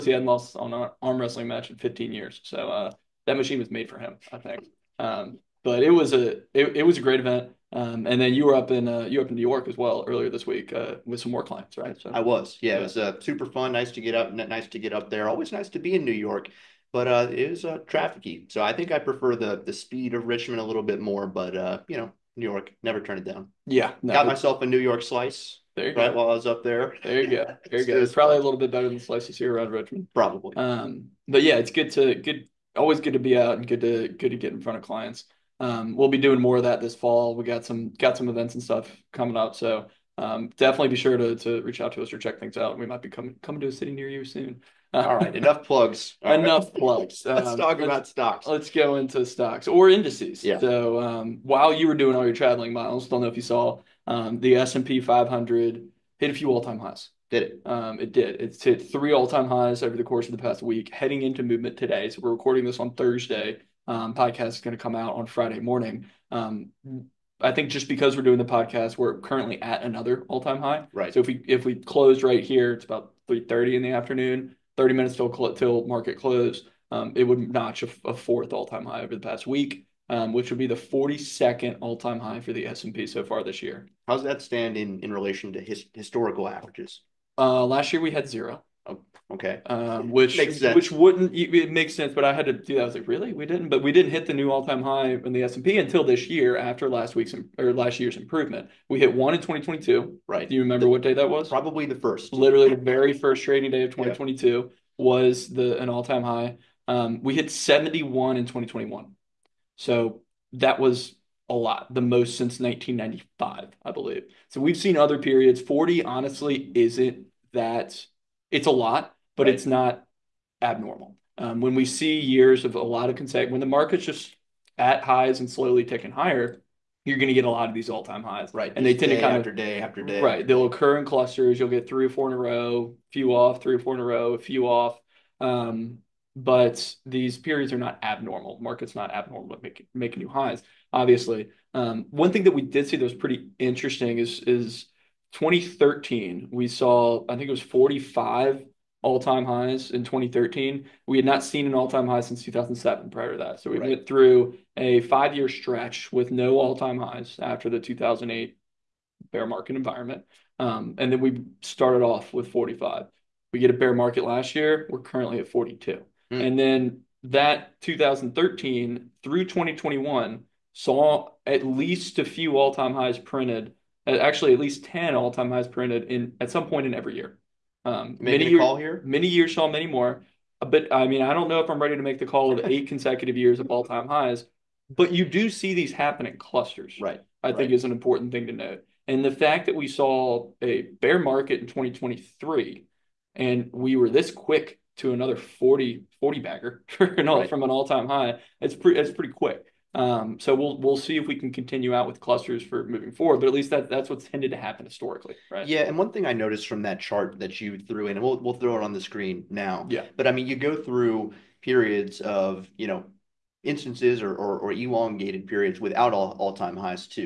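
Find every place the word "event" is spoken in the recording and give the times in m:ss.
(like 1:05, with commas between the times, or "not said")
0:07, 0:38.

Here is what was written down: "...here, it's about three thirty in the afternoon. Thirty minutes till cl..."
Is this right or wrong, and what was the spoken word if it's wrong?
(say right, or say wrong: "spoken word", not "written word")
right.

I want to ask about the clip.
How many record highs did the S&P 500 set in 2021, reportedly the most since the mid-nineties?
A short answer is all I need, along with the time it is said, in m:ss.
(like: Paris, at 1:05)
71, at 1:47.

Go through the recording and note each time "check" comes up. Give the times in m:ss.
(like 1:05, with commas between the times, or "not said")
0:42.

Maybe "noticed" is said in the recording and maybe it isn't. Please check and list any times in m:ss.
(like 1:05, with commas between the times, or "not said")
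3:26.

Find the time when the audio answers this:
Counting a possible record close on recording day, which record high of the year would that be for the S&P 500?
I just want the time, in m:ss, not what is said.
1:20.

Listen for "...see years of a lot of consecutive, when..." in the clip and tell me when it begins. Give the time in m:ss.
2:01.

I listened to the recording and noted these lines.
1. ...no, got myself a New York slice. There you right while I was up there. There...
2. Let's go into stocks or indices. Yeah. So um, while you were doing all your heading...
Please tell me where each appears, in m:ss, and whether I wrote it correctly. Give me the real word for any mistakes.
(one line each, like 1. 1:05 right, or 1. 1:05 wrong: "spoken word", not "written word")
1. 0:24 right
2. 0:48 wrong: "traveling", not "heading".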